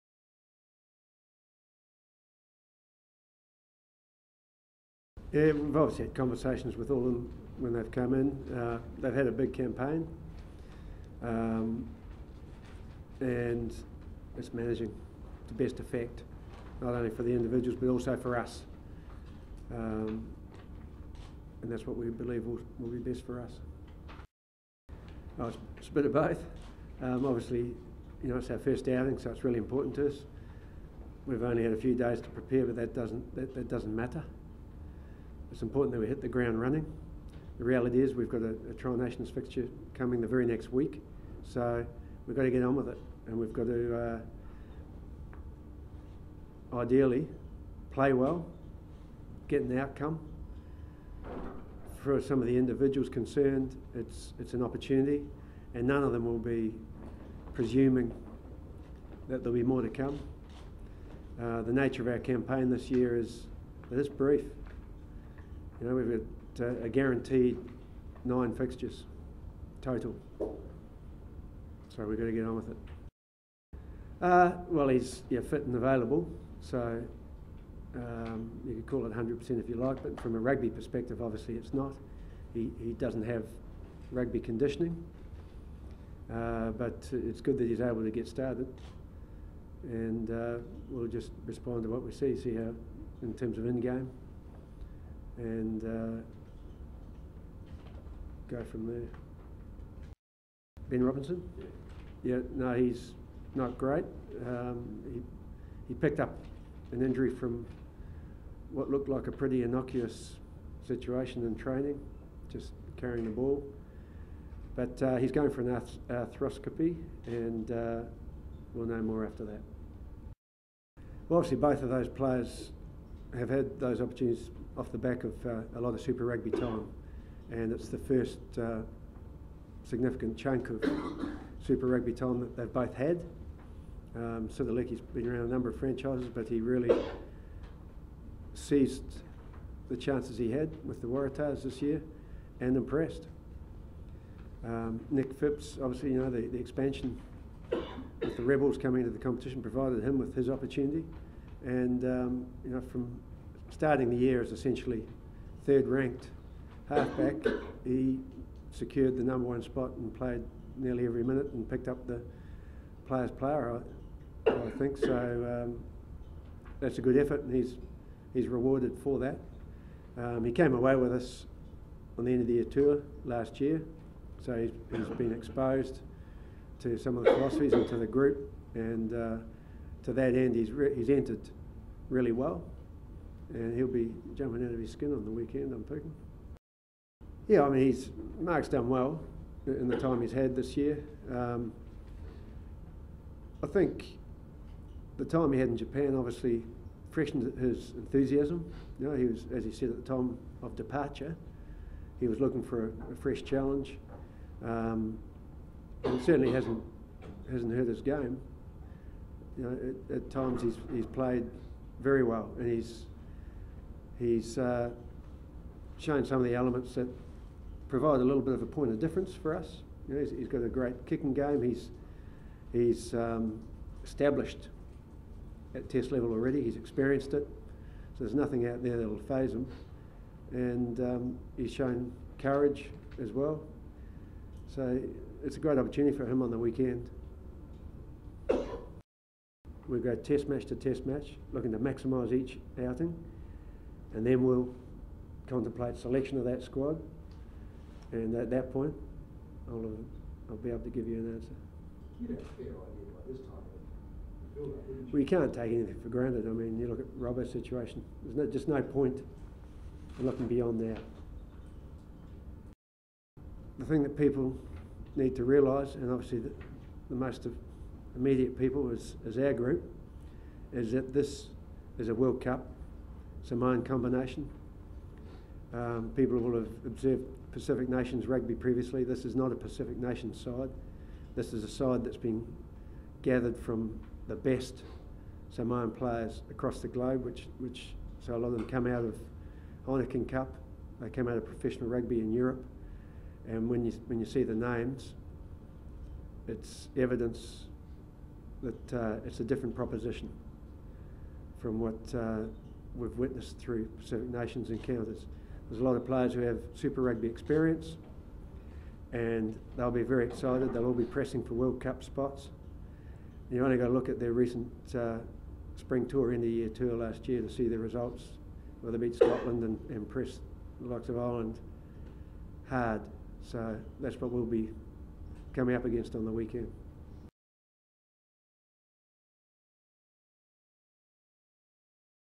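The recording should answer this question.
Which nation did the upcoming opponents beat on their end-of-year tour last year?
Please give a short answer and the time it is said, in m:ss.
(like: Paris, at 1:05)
Scotland, at 5:19.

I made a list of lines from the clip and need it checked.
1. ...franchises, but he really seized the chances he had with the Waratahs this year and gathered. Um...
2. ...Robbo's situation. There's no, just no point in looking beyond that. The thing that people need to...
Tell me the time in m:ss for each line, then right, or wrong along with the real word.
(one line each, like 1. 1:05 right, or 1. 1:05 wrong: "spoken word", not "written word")
1. 2:15 wrong: "impressed", not "gathered"
2. 4:17 right.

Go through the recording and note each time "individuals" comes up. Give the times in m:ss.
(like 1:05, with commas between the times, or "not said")
0:17, 0:52.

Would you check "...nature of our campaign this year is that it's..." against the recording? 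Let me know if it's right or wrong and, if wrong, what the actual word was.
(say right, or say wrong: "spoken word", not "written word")
right.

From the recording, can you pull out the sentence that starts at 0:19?
Um, and that's what we believe will, will be best for us.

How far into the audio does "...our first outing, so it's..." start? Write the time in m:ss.
0:28.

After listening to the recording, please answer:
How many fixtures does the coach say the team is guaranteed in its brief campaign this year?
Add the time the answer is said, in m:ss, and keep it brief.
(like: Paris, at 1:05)
9, at 1:08.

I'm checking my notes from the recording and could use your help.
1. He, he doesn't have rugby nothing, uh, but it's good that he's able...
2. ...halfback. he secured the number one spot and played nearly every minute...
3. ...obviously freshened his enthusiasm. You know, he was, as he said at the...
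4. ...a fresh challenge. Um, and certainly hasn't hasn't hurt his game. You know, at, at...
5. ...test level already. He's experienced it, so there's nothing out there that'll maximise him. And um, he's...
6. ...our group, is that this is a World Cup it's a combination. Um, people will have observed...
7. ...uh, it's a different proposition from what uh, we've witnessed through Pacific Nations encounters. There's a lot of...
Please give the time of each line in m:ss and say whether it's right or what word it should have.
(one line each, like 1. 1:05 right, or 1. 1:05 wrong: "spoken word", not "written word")
1. 1:22 wrong: "conditioning", not "nothing"
2. 2:36 right
3. 3:16 right
4. 3:23 right
5. 3:45 wrong: "phase", not "maximise"
6. 4:29 right
7. 4:58 right.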